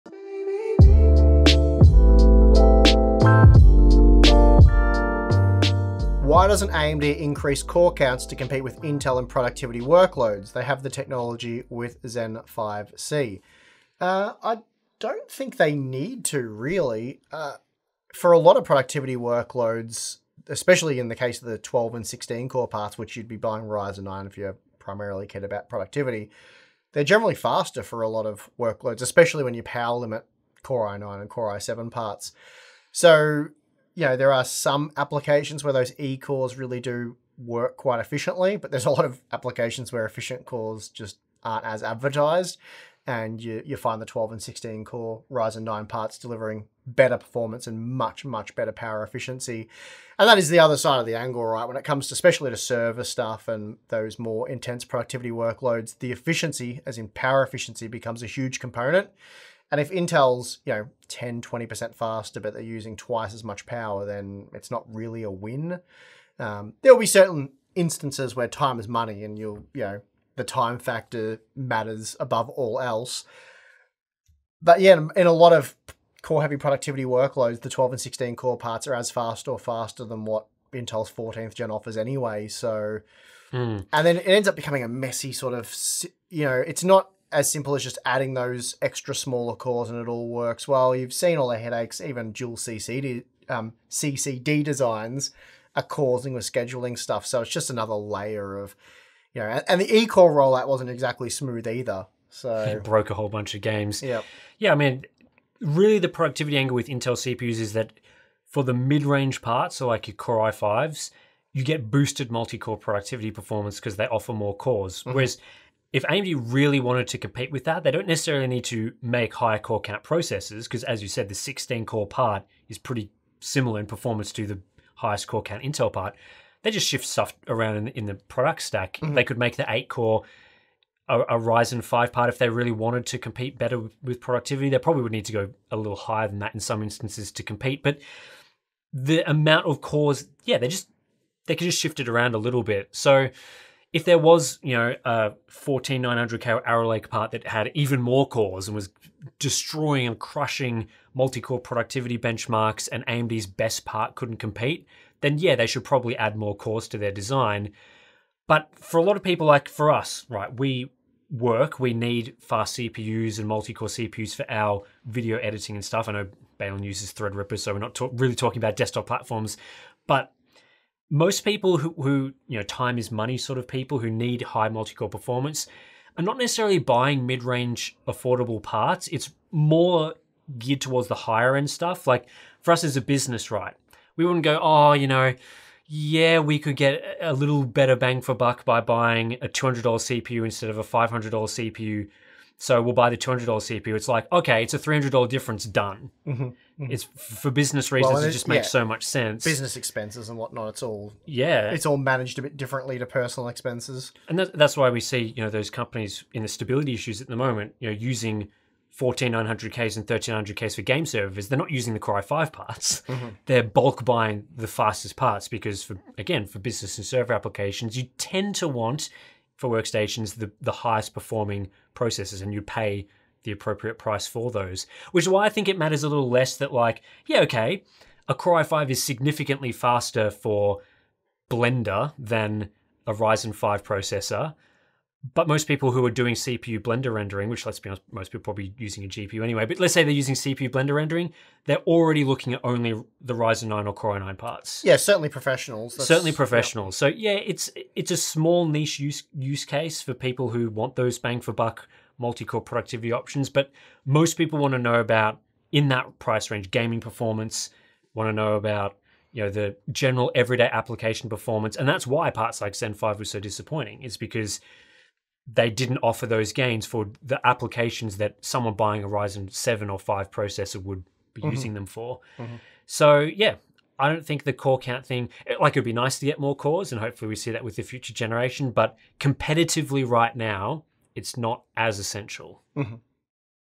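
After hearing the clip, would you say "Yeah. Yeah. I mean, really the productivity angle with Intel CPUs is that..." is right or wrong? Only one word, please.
right.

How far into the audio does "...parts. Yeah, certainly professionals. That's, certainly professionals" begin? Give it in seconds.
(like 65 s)
244 s.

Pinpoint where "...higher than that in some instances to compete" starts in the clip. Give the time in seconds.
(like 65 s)
135 s.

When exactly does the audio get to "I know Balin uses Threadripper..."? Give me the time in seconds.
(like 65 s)
166 s.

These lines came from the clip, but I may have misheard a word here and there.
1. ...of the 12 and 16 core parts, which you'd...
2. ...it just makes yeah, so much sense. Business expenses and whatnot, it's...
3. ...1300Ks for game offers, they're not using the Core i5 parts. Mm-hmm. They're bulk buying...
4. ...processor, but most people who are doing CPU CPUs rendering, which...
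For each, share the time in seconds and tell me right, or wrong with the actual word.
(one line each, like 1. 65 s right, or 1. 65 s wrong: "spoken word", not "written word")
1. 21 s right
2. 198 s right
3. 210 s wrong: "servers", not "offers"
4. 233 s wrong: "Blender", not "CPUs".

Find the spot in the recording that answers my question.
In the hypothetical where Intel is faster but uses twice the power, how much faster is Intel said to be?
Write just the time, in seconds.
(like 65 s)
61 s.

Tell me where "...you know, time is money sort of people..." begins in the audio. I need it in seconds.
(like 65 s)
172 s.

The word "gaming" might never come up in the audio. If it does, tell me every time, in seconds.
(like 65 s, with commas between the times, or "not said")
256 s.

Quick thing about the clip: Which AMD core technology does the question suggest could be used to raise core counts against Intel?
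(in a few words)
Zen 5C.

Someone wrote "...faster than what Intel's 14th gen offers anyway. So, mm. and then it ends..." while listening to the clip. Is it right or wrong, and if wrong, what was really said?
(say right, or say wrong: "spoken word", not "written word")
right.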